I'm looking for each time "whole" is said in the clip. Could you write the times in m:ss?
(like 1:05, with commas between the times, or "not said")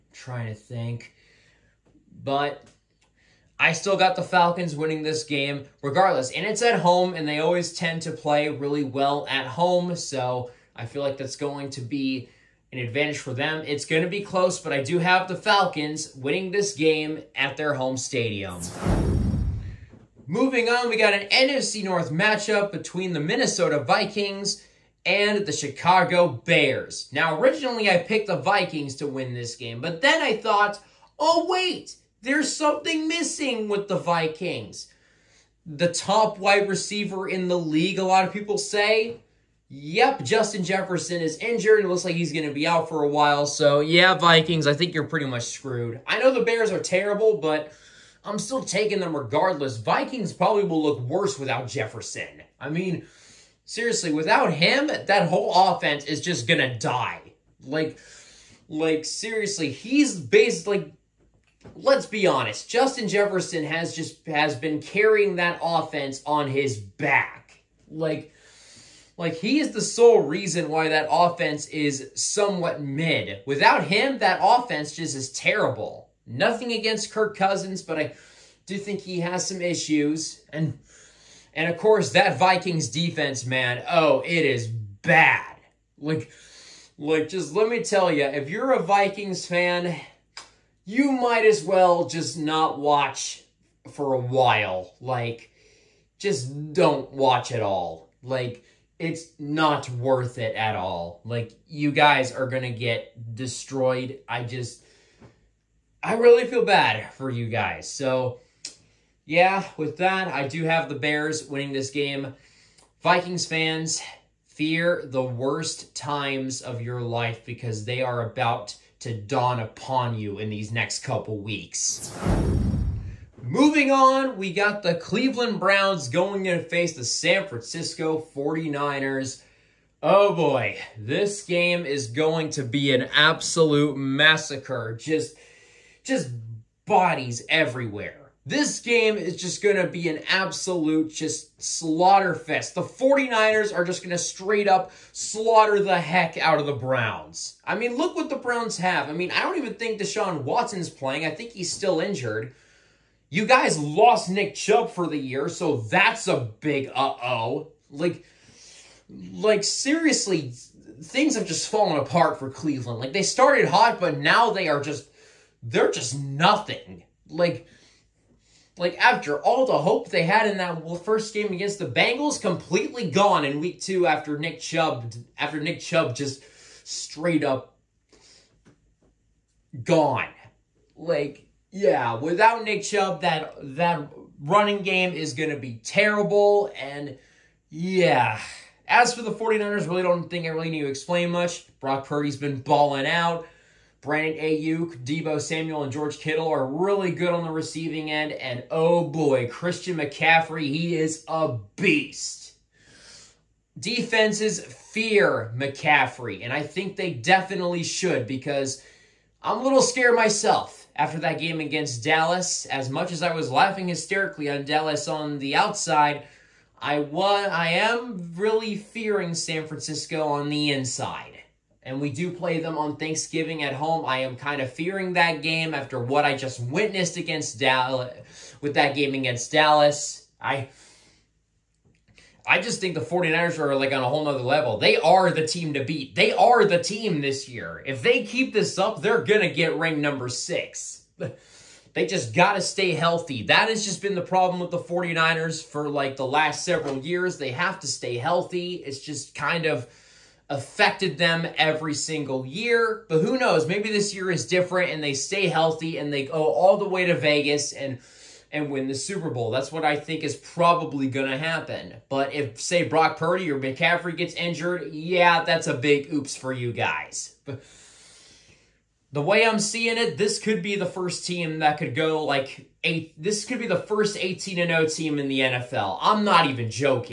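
0:55, 3:54.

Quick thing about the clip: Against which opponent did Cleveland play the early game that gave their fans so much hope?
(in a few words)
Bengals.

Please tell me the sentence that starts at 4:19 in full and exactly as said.
That's what I think is probably going to happen.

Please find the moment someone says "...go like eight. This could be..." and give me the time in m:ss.
4:31.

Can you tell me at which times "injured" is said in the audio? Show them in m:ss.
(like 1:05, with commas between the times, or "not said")
0:41, 2:32, 4:24.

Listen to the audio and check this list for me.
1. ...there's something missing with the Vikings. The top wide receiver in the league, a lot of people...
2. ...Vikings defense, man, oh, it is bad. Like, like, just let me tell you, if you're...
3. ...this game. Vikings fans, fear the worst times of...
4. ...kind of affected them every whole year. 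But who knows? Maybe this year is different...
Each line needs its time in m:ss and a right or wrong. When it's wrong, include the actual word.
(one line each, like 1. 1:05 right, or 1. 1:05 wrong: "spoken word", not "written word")
1. 0:32 right
2. 1:22 right
3. 1:51 right
4. 4:09 wrong: "single", not "whole".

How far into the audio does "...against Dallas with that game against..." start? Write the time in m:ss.
3:47.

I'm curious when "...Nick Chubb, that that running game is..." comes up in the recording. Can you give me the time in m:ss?
3:02.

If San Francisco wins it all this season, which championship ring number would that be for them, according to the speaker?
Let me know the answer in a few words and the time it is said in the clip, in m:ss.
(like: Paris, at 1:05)
6, at 3:59.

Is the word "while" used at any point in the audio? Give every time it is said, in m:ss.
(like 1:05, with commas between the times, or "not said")
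0:43, 1:34.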